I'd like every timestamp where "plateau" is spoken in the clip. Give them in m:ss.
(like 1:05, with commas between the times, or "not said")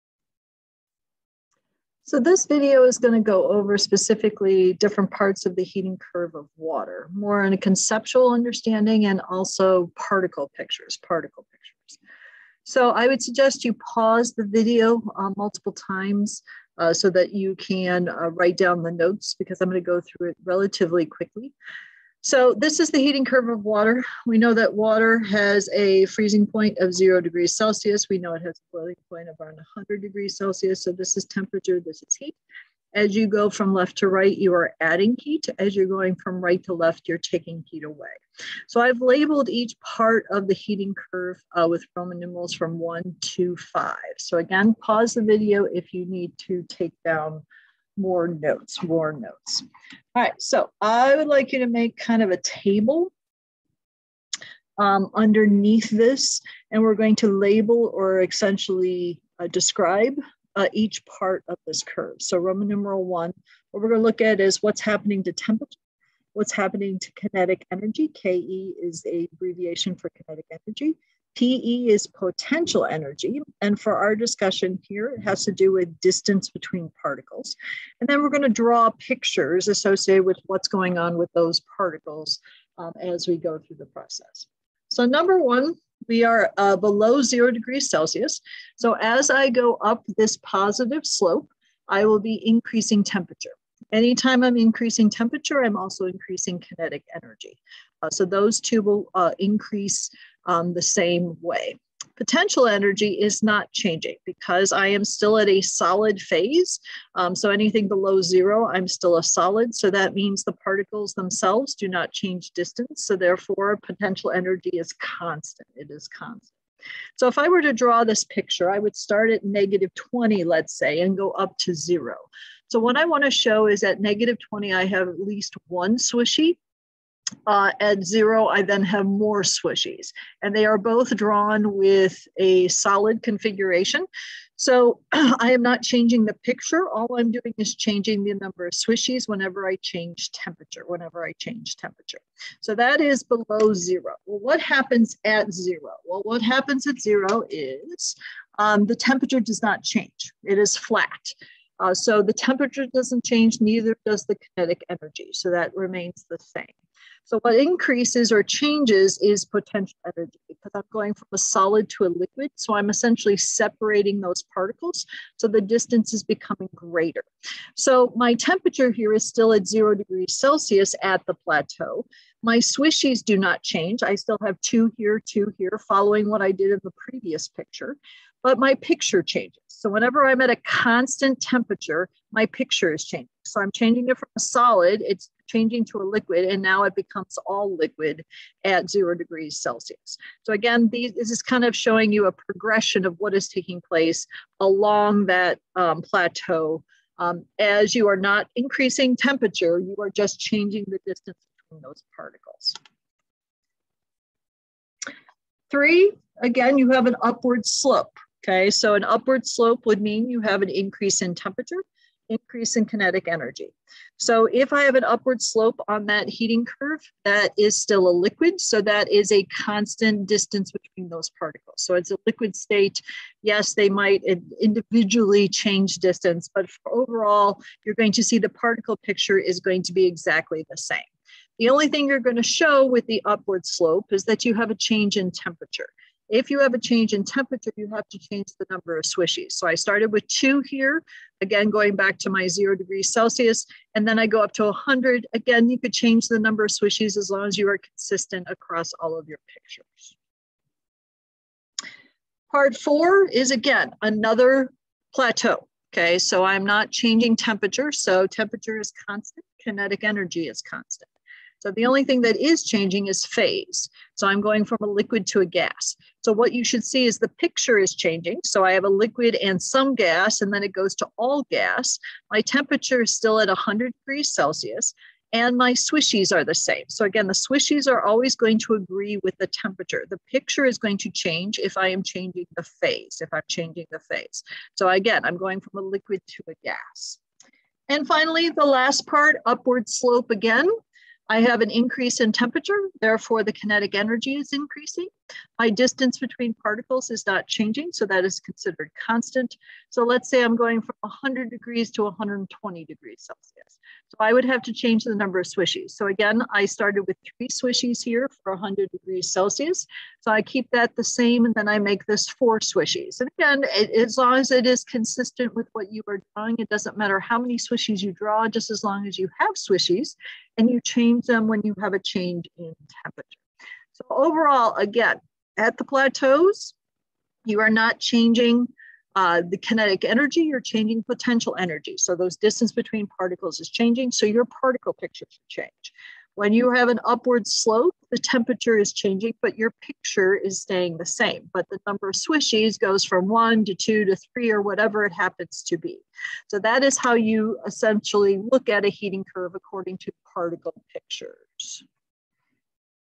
2:51, 3:16, 4:15, 5:25.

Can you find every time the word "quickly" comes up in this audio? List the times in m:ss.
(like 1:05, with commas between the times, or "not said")
0:21.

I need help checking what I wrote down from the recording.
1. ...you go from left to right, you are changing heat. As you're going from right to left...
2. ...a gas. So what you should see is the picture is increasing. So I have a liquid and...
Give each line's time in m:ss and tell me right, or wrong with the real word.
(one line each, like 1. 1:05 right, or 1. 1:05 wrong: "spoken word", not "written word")
1. 0:33 wrong: "adding", not "changing"
2. 4:25 wrong: "changing", not "increasing".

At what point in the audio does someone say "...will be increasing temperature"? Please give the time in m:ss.
1:32.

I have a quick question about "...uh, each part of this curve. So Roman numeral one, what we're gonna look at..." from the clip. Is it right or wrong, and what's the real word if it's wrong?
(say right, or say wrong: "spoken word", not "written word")
right.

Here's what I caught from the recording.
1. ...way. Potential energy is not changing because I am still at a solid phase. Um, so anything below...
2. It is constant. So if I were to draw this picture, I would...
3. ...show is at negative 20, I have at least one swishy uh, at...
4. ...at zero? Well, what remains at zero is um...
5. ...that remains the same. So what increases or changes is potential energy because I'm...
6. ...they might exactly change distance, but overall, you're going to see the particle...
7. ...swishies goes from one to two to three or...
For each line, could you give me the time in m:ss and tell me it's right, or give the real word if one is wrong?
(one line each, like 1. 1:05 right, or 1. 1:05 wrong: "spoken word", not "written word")
1. 1:41 right
2. 1:55 right
3. 2:03 right
4. 2:25 wrong: "happens", not "remains"
5. 2:35 right
6. 3:43 wrong: "individually", not "exactly"
7. 5:42 right.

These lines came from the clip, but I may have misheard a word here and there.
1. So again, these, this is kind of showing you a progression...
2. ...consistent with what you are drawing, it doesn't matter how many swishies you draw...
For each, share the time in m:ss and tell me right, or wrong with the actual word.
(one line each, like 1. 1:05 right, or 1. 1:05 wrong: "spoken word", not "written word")
1. 3:10 right
2. 5:14 right.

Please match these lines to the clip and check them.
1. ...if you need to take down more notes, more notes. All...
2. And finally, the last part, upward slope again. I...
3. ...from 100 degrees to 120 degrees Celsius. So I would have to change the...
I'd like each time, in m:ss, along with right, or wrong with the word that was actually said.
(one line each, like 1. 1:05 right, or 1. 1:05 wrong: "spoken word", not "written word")
1. 0:45 right
2. 4:47 right
3. 5:00 right.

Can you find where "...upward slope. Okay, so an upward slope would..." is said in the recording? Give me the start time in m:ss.
3:27.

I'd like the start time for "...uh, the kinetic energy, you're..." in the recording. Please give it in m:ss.
5:29.